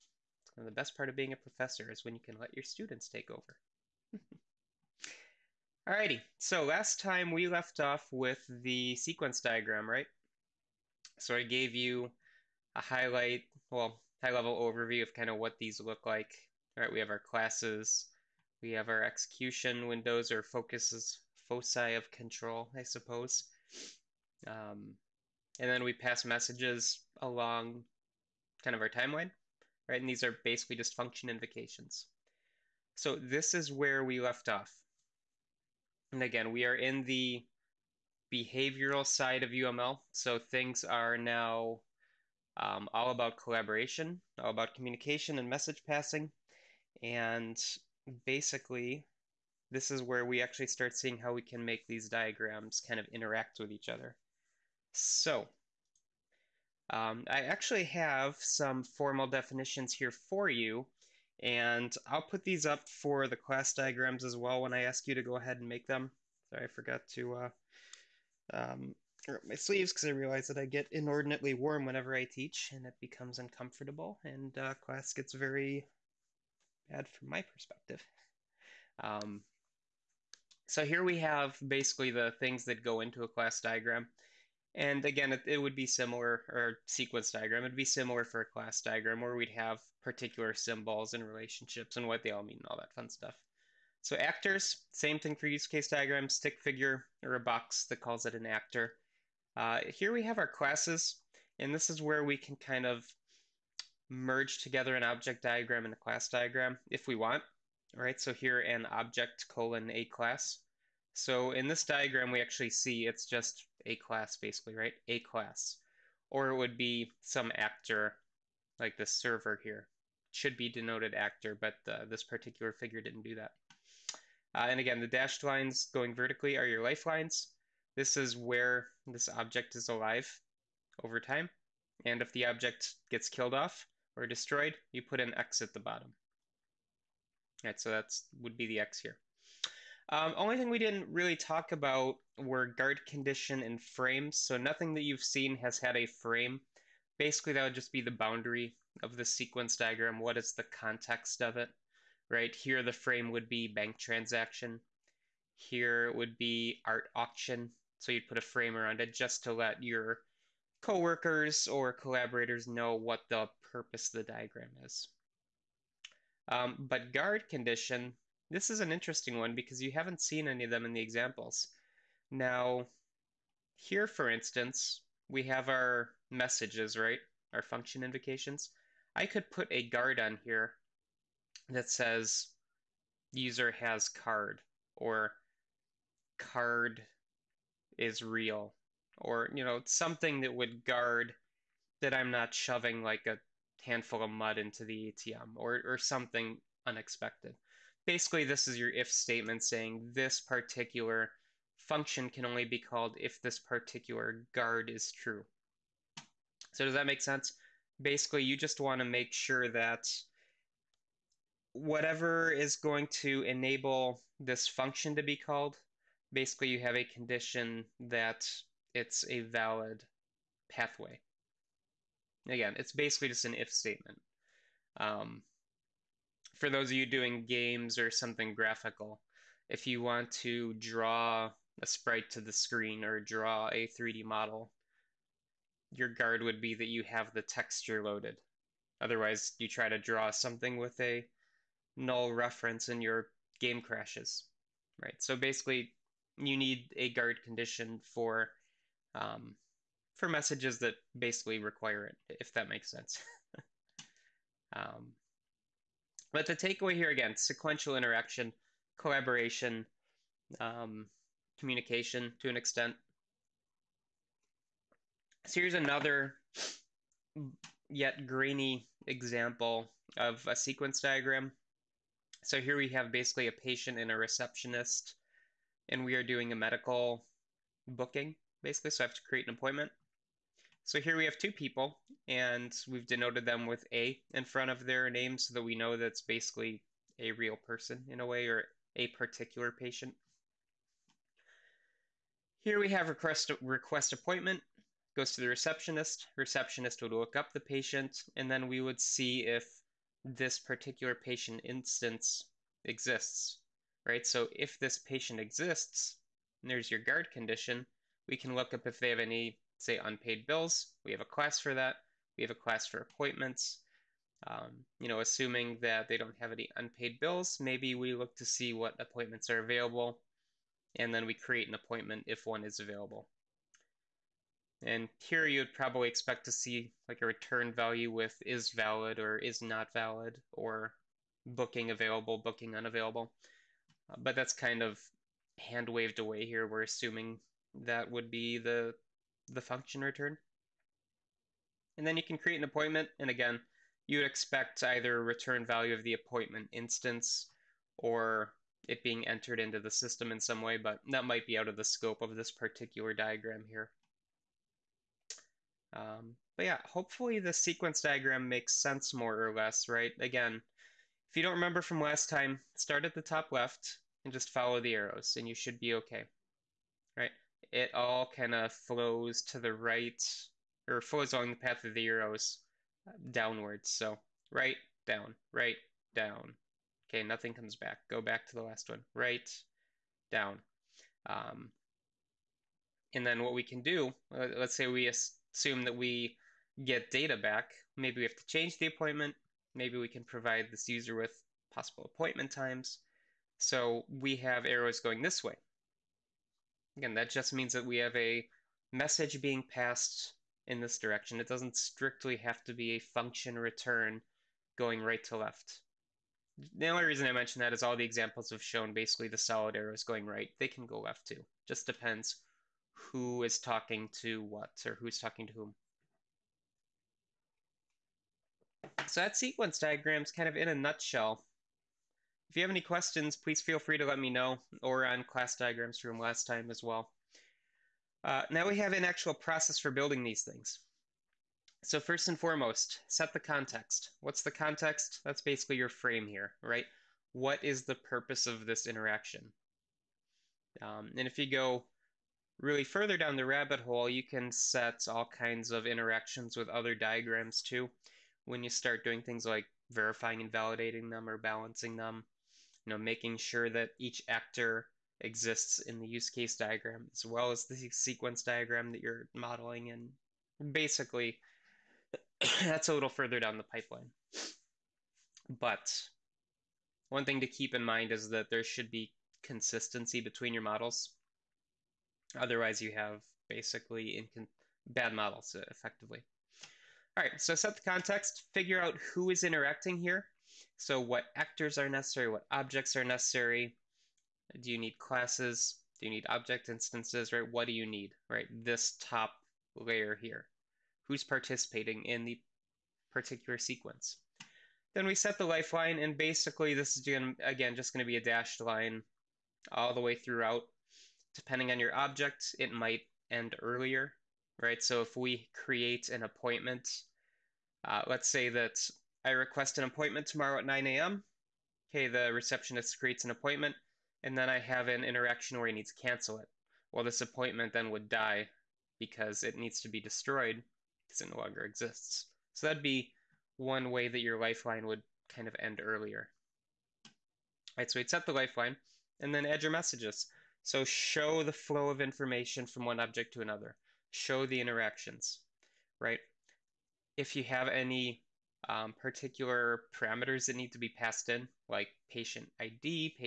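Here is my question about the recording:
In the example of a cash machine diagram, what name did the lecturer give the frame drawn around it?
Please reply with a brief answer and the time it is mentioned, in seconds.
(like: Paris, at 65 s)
bank transaction, at 153 s.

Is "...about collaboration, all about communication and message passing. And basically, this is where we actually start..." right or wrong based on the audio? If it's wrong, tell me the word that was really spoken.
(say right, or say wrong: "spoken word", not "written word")
right.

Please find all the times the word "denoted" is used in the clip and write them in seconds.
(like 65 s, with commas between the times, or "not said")
120 s, 283 s.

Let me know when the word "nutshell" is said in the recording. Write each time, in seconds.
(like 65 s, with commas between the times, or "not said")
420 s.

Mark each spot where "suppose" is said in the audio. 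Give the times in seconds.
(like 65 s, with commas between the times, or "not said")
22 s.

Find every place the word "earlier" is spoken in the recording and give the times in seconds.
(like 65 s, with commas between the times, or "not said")
503 s, 525 s.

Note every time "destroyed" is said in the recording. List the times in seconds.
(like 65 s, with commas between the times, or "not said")
134 s, 519 s.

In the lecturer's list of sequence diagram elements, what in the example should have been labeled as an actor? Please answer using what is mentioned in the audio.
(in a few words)
server.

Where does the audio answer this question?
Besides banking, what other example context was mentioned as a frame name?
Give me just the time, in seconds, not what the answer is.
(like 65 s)
156 s.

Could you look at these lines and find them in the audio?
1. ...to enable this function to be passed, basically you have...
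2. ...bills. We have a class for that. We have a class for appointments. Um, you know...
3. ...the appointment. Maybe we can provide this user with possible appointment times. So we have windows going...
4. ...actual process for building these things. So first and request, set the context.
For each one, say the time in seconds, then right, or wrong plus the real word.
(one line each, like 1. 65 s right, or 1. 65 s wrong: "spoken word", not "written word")
1. 213 s wrong: "called", not "passed"
2. 310 s right
3. 388 s wrong: "arrows", not "windows"
4. 429 s wrong: "foremost", not "request".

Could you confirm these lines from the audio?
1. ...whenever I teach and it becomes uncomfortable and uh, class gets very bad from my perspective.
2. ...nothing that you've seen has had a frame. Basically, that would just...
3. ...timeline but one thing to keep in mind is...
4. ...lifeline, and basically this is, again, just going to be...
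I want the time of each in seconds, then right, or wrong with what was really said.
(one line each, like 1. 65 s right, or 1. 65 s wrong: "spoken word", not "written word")
1. 71 s right
2. 144 s right
3. 463 s wrong: "pipeline", not "timeline"
4. 495 s right.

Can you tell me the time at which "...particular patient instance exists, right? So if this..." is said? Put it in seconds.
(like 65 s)
300 s.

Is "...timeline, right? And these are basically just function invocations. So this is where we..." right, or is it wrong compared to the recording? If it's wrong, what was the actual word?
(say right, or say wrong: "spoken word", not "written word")
right.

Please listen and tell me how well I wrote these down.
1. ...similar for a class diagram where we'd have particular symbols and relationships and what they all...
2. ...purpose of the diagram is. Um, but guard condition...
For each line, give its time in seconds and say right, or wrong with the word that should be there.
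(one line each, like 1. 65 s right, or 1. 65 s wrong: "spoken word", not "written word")
1. 87 s right
2. 163 s right.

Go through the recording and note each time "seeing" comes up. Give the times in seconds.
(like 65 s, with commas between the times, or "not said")
50 s.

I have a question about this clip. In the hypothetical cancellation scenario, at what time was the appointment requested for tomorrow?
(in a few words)
9 a.m.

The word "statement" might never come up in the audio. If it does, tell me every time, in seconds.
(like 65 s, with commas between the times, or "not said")
199 s, 223 s.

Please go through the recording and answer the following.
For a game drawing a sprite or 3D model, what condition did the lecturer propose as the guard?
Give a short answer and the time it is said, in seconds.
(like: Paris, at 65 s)
texture loaded, at 237 s.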